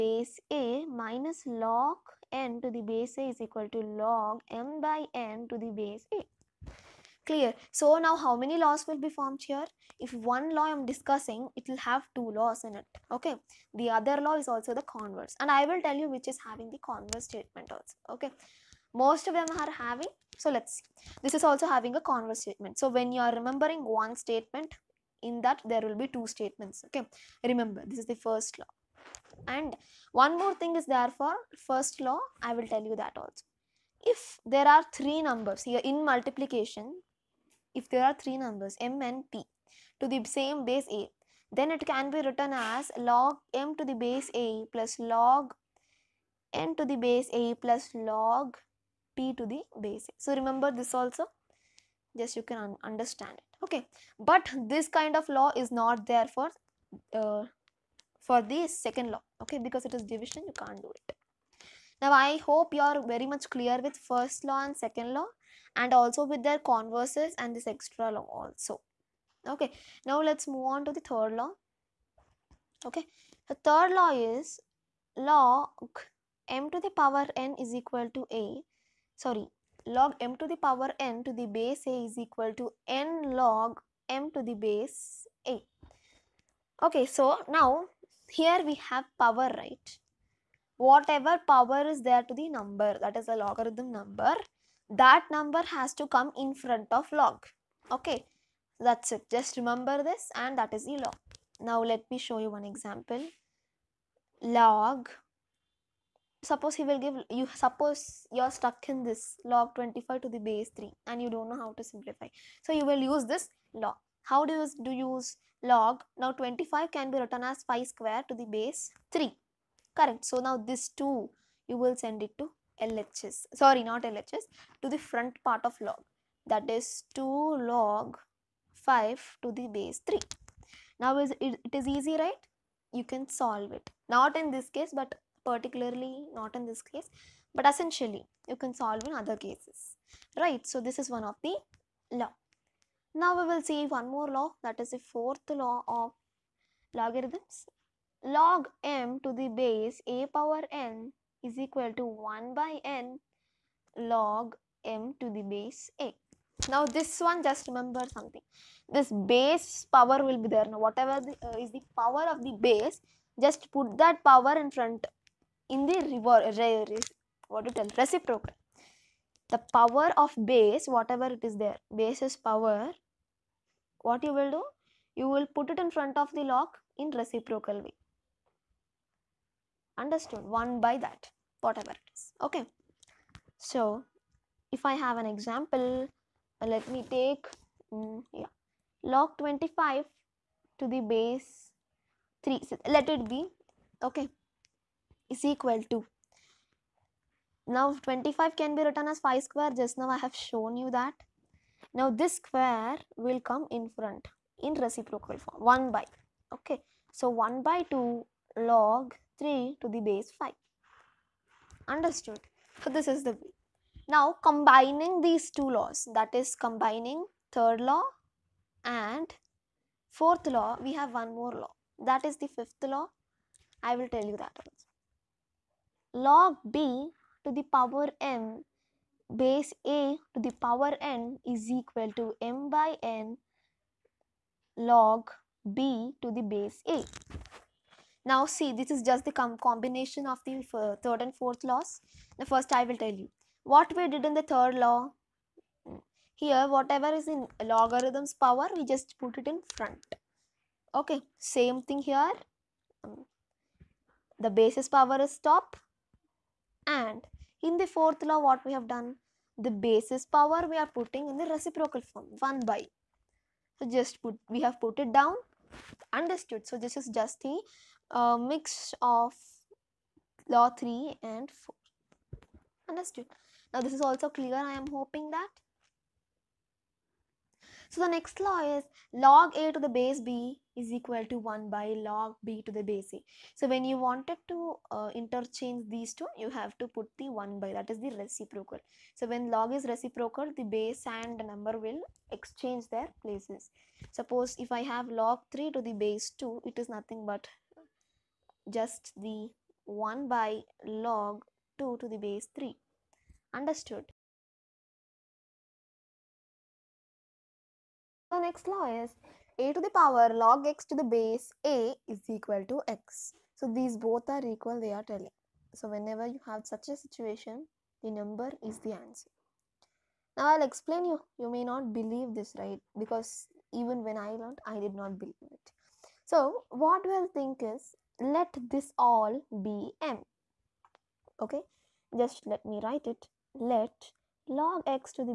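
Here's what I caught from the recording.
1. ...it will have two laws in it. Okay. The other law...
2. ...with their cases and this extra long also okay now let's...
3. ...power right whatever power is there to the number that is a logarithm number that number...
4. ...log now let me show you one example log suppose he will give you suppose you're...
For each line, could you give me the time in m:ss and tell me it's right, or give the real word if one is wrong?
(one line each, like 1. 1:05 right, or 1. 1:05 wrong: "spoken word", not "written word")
1. 0:11 right
2. 1:06 wrong: "converses", not "cases"
3. 1:29 right
4. 1:40 right.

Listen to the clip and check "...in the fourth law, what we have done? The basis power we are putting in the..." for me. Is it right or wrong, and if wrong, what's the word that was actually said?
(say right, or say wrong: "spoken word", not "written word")
right.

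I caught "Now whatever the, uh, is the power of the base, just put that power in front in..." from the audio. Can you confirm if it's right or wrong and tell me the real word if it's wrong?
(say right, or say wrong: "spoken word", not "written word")
right.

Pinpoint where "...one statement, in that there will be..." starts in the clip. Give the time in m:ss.
0:23.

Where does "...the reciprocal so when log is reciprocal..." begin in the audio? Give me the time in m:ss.
4:48.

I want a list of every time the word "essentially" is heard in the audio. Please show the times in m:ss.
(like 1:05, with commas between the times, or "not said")
2:17.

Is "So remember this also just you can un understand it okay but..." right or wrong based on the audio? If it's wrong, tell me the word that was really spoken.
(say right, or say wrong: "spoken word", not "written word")
right.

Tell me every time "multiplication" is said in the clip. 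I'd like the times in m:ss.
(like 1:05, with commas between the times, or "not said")
0:36.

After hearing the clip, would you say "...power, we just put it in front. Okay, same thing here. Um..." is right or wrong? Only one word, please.
right.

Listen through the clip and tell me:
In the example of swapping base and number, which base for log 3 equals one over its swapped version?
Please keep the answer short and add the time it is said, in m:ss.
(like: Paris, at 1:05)
2, at 4:55.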